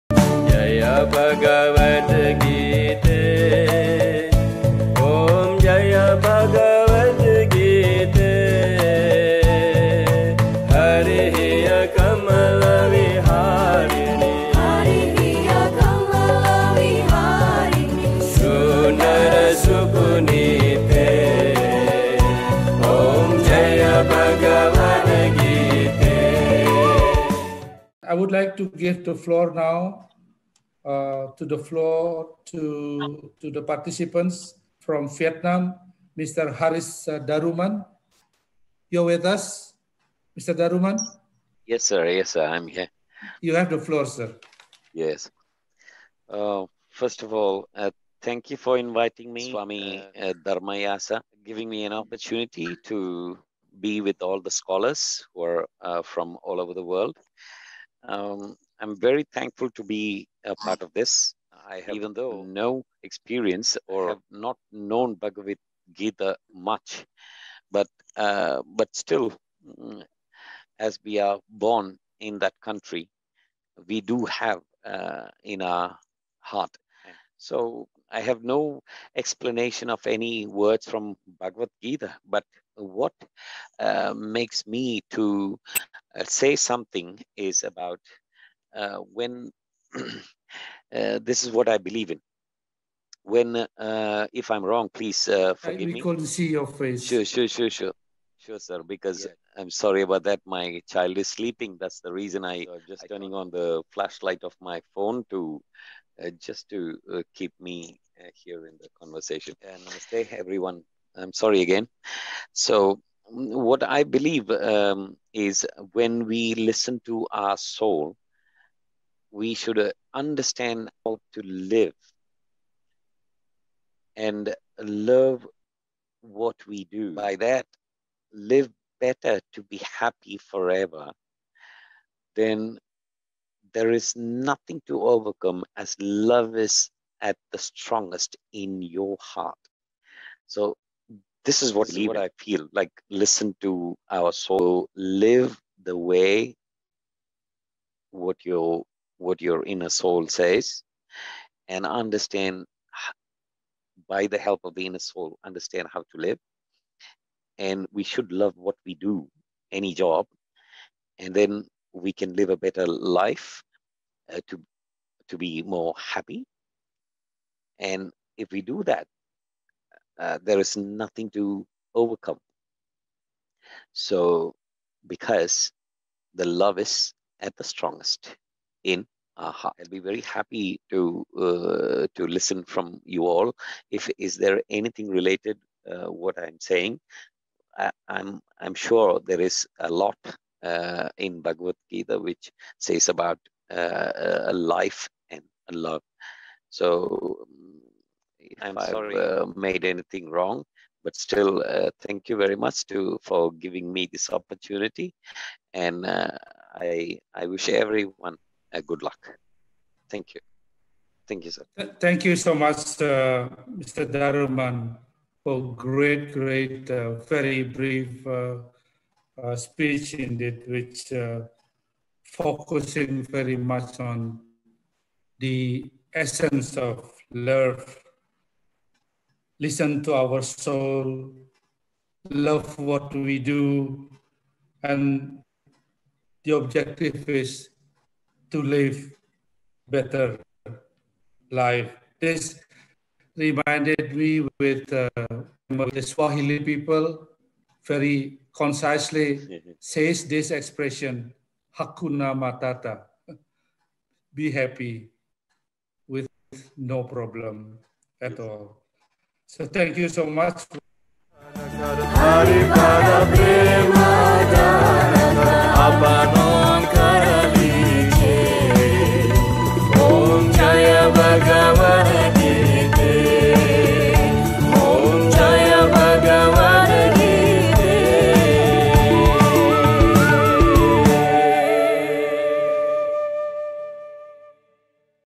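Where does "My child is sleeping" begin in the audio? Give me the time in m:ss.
1:40.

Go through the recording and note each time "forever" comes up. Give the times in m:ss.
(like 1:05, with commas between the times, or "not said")
2:10.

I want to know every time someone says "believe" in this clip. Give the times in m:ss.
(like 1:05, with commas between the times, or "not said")
1:31, 1:54.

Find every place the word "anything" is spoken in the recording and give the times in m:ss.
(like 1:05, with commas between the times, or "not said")
3:04, 3:19.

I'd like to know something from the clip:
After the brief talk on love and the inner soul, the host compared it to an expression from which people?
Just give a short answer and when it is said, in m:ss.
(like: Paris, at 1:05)
Swahili, at 4:06.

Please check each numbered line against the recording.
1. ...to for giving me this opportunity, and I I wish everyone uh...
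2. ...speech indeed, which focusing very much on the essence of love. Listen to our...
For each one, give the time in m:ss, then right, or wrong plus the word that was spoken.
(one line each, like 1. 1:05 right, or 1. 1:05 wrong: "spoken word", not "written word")
1. 3:22 right
2. 3:39 right.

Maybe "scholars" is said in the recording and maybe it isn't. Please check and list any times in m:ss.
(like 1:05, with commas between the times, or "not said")
0:54.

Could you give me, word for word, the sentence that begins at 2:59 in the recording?
I'll be very happy to uh, to listen from you all.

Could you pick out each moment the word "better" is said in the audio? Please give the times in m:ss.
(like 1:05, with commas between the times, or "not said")
2:08, 2:42, 3:59.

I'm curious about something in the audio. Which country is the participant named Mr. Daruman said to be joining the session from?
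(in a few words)
Vietnam.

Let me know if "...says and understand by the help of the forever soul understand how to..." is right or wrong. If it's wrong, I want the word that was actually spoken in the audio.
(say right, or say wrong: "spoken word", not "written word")
wrong: "inner", not "forever".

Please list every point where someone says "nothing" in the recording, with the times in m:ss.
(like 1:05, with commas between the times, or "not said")
2:14, 2:50.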